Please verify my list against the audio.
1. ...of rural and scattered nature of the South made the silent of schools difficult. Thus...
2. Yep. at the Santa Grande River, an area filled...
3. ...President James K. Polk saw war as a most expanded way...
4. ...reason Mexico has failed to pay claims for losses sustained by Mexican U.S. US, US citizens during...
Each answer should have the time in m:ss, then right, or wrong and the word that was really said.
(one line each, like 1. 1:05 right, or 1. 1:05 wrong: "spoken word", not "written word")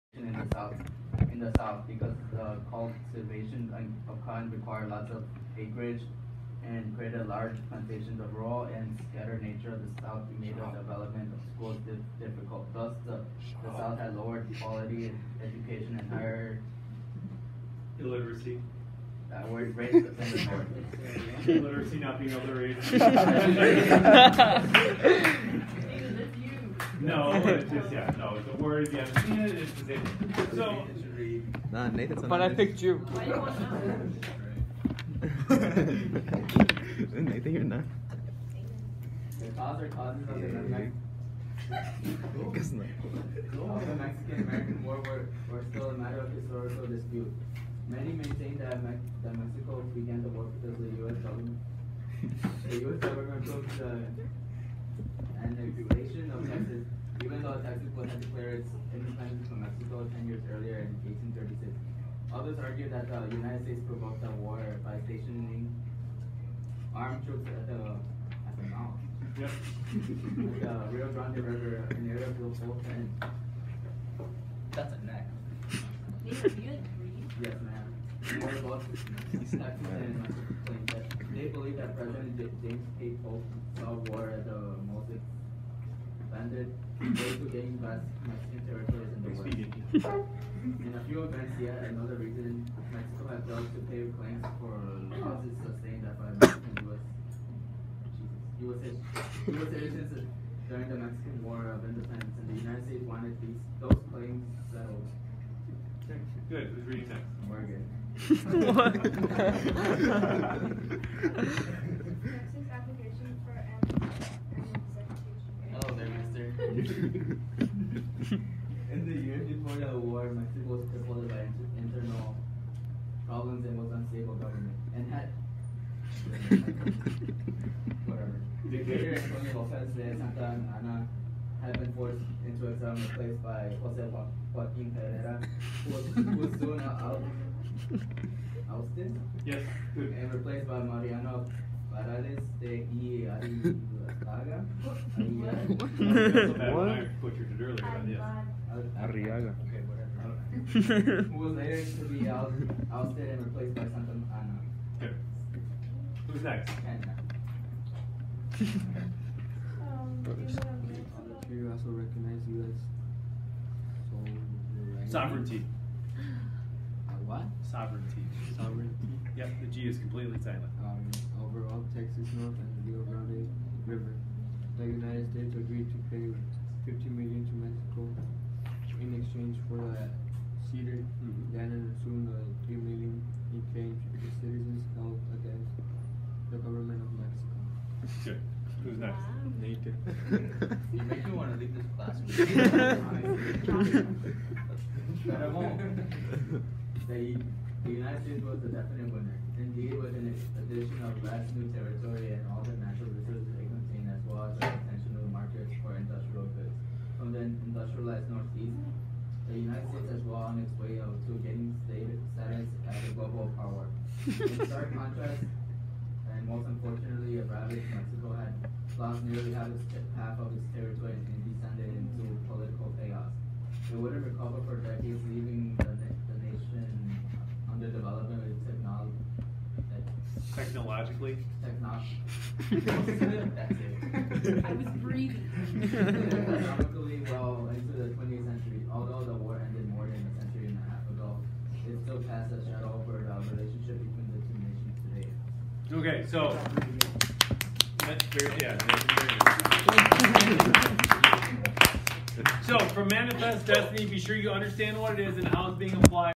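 1. 0:08 wrong: "development", not "silent"
2. 1:09 wrong: "Rio", not "Santa"
3. 1:21 right
4. 1:32 right.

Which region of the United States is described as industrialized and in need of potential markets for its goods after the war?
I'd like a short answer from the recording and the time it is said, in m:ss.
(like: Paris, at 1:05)
Northeast, at 3:28.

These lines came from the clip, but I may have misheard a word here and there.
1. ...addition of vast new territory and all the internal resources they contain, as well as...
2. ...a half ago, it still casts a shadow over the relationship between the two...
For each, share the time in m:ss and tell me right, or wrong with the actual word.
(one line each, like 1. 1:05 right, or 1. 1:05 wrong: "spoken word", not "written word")
1. 3:20 wrong: "natural", not "internal"
2. 4:00 right.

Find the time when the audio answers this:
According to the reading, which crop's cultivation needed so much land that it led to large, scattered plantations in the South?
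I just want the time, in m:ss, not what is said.
0:04.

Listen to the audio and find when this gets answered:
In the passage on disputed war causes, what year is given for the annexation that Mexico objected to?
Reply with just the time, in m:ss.
1:01.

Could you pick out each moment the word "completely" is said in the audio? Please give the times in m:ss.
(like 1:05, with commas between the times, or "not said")
2:49.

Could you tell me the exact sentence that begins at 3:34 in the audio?
In stark contrast, and most unfortunately, a ravaged Mexico had lost nearly half, of its territory and descended into political chaos.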